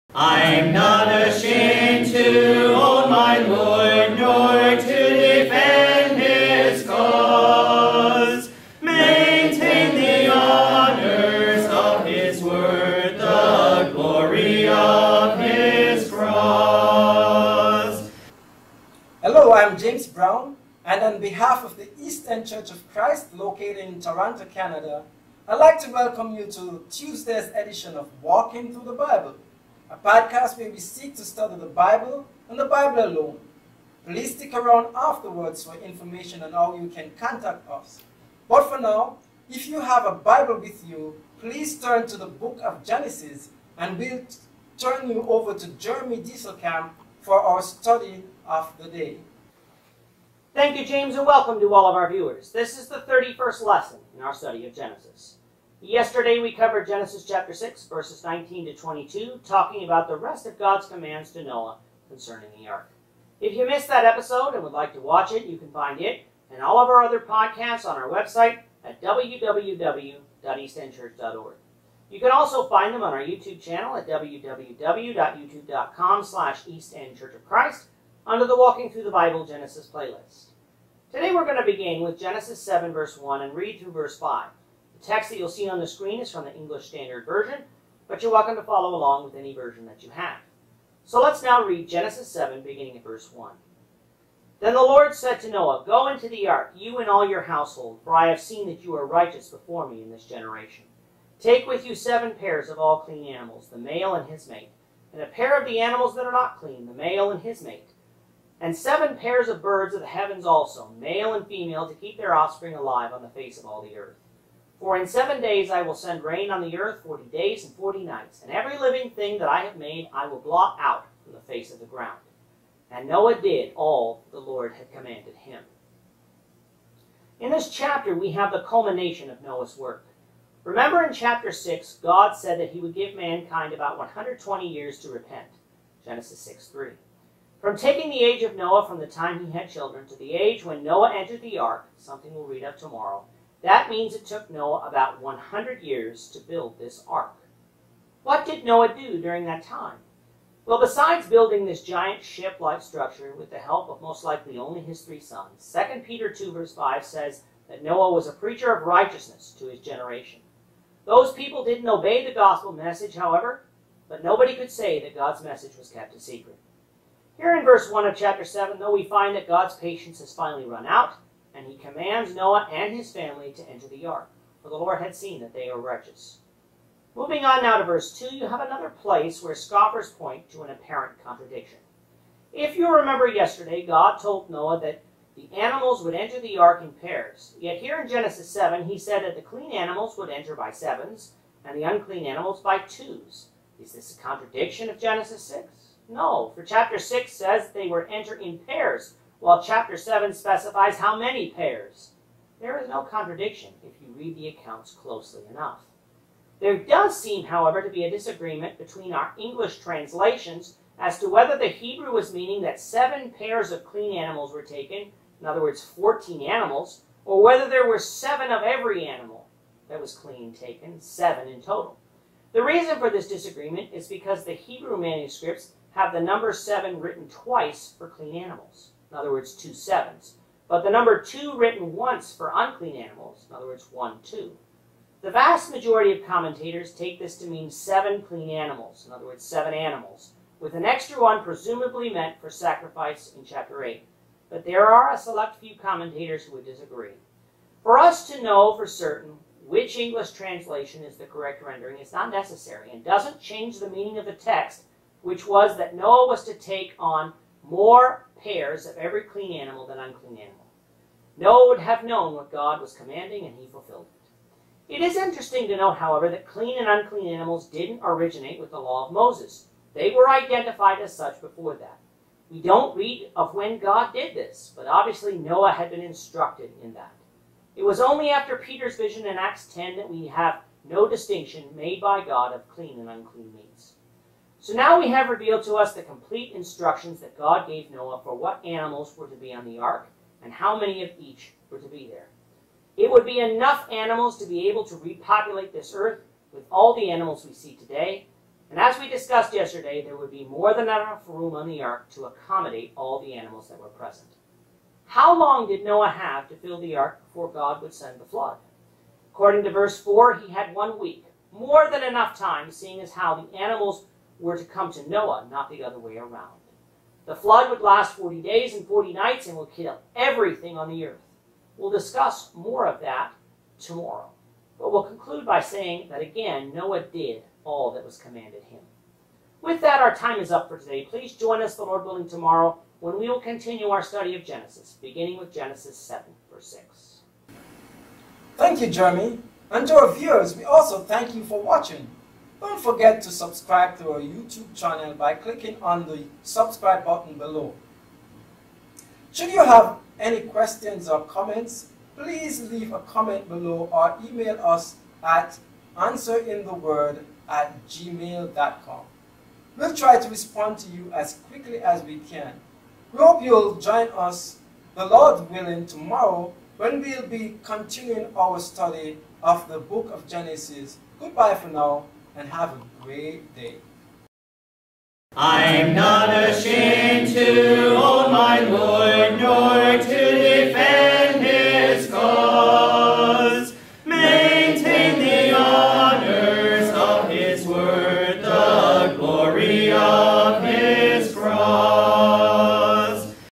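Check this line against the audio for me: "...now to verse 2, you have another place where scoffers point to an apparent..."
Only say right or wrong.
right.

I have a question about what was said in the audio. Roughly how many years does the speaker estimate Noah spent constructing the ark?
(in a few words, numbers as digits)
100 years.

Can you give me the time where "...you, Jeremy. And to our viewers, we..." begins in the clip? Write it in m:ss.
5:38.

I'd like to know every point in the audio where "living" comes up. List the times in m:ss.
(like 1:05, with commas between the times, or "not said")
1:58.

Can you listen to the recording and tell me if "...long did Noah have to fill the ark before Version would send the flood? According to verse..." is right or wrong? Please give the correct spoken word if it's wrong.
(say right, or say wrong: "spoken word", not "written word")
wrong: "God", not "Version".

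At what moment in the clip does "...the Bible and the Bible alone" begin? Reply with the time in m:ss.
0:31.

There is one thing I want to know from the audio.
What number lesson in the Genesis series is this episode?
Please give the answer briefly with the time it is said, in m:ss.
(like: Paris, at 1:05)
31st, at 0:53.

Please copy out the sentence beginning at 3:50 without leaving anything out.
But the number two written once for unclean animals, in other words, one, two.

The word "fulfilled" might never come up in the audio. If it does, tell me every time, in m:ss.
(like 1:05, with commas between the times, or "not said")
4:23.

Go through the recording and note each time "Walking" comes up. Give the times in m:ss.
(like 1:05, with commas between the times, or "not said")
0:28, 1:18.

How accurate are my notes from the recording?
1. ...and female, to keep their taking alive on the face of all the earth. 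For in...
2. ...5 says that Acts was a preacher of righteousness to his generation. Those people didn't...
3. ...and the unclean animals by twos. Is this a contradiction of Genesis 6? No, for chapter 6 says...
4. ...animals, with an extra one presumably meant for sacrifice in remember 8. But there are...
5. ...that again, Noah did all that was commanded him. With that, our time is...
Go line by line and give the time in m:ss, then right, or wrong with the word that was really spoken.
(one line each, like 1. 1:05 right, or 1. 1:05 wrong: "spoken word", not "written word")
1. 1:51 wrong: "offspring", not "taking"
2. 2:36 wrong: "Noah", not "Acts"
3. 3:11 right
4. 3:59 wrong: "chapter", not "remember"
5. 5:26 right.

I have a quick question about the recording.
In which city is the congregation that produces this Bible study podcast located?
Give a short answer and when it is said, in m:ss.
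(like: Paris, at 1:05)
Toronto, at 0:24.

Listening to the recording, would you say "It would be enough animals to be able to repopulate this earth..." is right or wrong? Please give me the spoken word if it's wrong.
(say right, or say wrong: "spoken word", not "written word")
right.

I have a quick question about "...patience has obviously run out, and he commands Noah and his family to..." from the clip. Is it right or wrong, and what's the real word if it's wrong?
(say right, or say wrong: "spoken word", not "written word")
wrong: "finally", not "obviously".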